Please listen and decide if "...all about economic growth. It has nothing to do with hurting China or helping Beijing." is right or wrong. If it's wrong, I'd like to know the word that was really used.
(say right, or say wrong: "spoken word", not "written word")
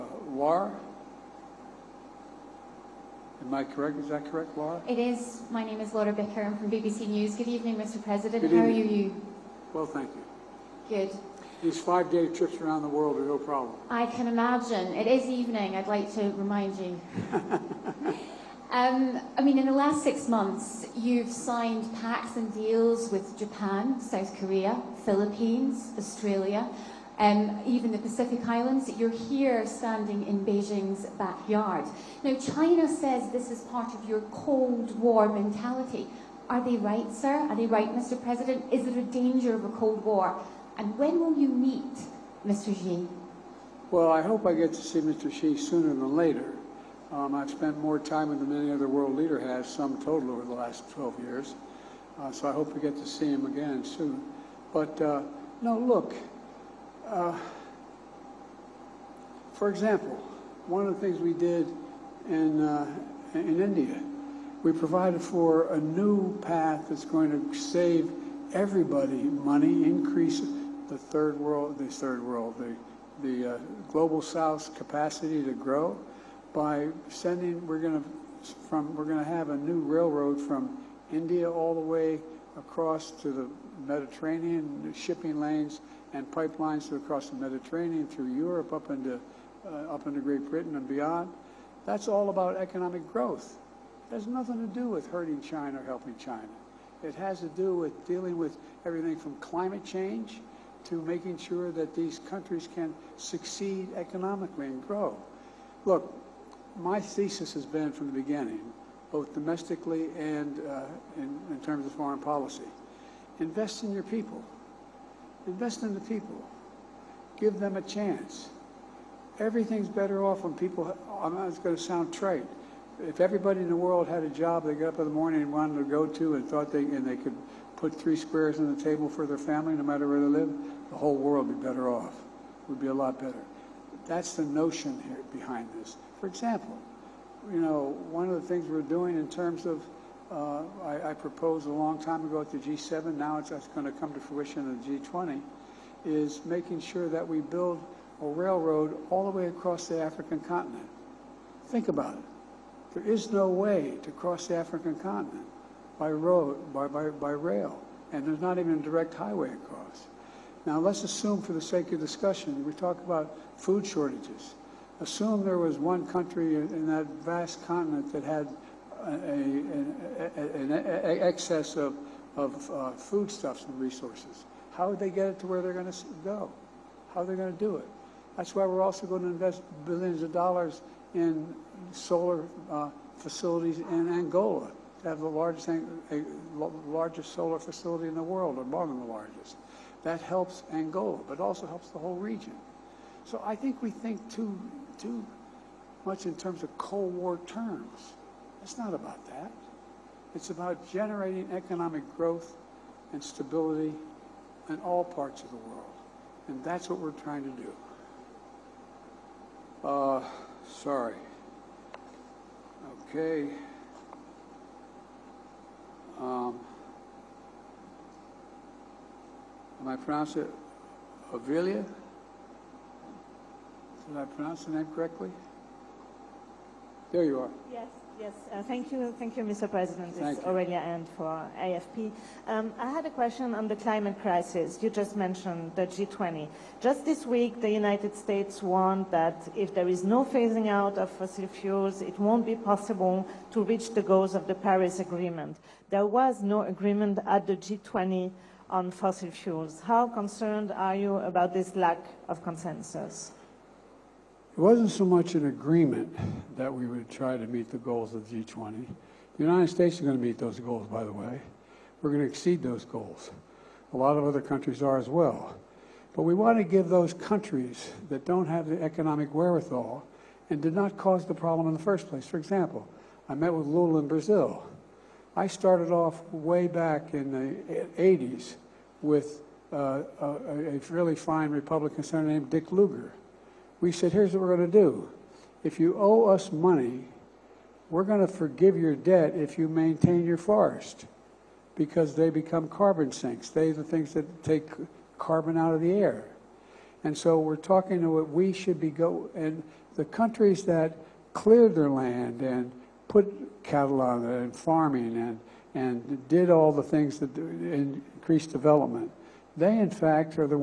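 wrong: "China", not "Beijing".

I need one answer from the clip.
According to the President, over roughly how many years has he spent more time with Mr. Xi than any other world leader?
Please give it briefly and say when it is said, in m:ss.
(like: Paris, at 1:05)
12, at 0:50.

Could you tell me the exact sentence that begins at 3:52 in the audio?
Um, I had a question on the climate crisis.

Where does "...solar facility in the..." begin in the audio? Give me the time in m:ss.
3:07.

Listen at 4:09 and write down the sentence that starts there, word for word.
How concerned are you about this lack of consensus?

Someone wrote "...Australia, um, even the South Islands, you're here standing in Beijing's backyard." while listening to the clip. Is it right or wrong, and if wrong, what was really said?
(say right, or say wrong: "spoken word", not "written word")
wrong: "Pacific", not "South".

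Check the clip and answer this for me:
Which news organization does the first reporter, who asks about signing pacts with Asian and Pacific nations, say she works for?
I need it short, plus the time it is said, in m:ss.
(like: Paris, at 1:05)
BBC News, at 0:06.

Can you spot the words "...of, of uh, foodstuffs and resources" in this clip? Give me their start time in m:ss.
2:51.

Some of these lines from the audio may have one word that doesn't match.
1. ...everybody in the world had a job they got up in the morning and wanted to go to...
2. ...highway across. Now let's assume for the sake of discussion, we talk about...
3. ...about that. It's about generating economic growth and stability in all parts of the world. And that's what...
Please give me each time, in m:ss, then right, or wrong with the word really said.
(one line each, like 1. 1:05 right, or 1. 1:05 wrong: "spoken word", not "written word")
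1. 2:03 right
2. 2:39 right
3. 3:18 right.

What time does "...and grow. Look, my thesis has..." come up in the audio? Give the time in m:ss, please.
1:44.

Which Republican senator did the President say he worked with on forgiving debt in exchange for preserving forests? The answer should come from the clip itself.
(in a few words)
Dick Lugar.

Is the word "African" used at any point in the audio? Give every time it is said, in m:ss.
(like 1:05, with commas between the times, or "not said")
2:30, 2:34.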